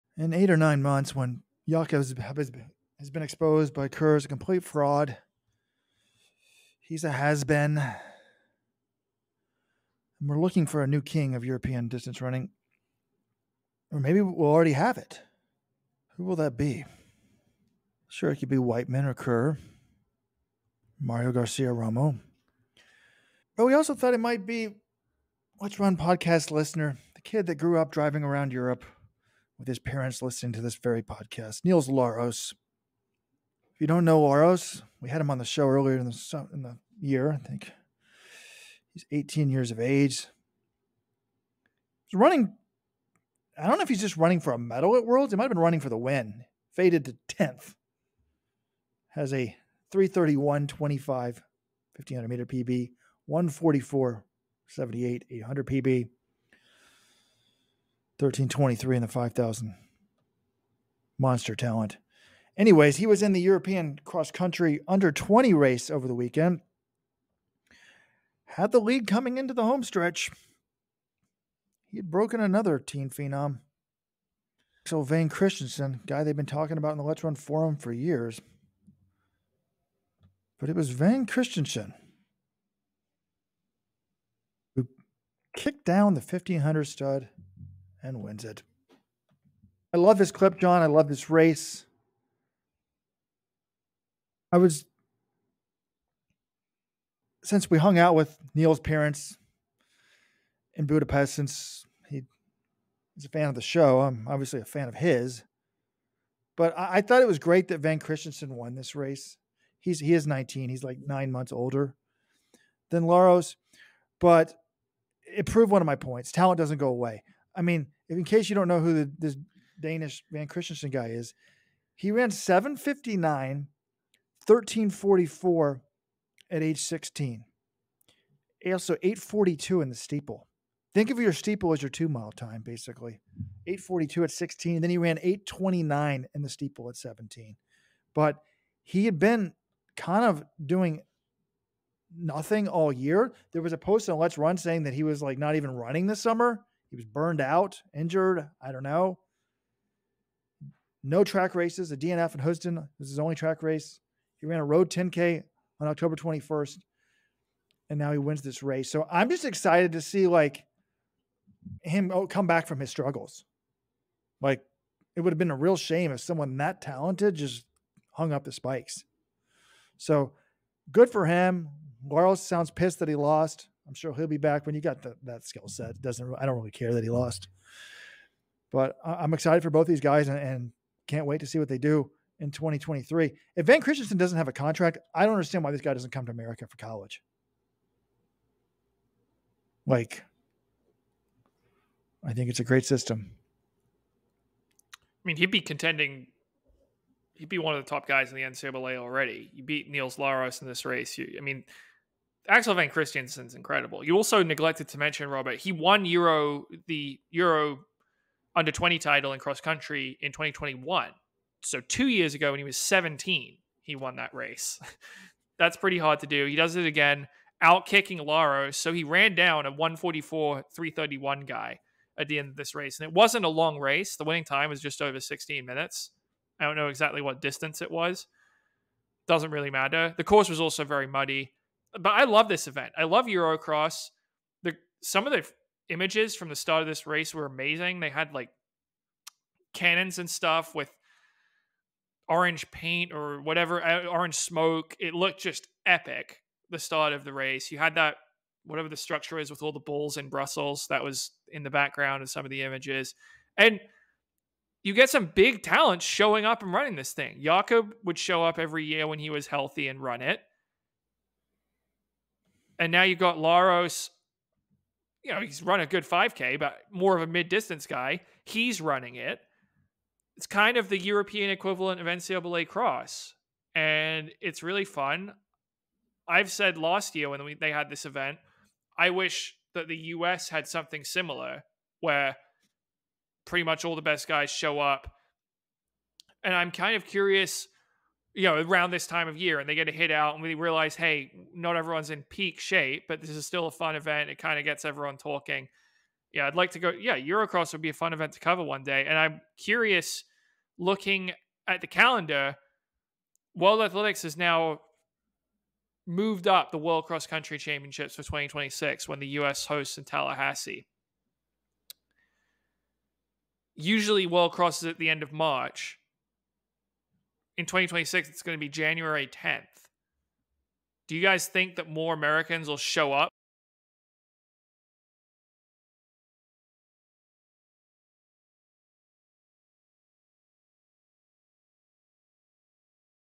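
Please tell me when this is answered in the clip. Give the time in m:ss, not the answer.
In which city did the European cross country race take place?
4:10.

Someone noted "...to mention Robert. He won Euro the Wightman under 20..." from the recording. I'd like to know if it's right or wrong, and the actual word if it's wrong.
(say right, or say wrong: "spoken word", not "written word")
wrong: "Euro", not "Wightman".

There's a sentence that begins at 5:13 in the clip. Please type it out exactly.
Usually, World Cross is at the end of March in 2026, it's going to be January 10th.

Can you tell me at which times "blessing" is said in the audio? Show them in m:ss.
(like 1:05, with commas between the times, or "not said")
not said.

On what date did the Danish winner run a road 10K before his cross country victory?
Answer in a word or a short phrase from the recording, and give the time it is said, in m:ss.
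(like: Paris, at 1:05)
October 21st, at 2:35.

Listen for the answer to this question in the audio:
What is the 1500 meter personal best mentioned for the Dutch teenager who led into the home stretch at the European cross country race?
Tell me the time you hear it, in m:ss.
0:49.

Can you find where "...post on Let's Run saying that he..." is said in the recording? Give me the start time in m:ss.
2:23.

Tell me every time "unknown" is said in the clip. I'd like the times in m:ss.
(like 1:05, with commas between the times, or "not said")
not said.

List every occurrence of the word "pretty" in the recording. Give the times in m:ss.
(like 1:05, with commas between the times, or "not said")
3:35, 4:43.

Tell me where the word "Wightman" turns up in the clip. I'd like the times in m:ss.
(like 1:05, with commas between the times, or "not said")
0:18.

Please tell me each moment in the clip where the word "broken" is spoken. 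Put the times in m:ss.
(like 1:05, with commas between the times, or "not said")
1:12.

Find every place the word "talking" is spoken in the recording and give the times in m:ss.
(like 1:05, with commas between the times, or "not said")
1:16, 4:55.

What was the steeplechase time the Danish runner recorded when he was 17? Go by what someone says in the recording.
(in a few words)
8:29.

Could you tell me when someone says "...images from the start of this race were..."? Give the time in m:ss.
3:55.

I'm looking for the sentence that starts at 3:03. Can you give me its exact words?
If Vang Christensen doesn't have a contract, I don't understand why this guy doesn't come to America for college.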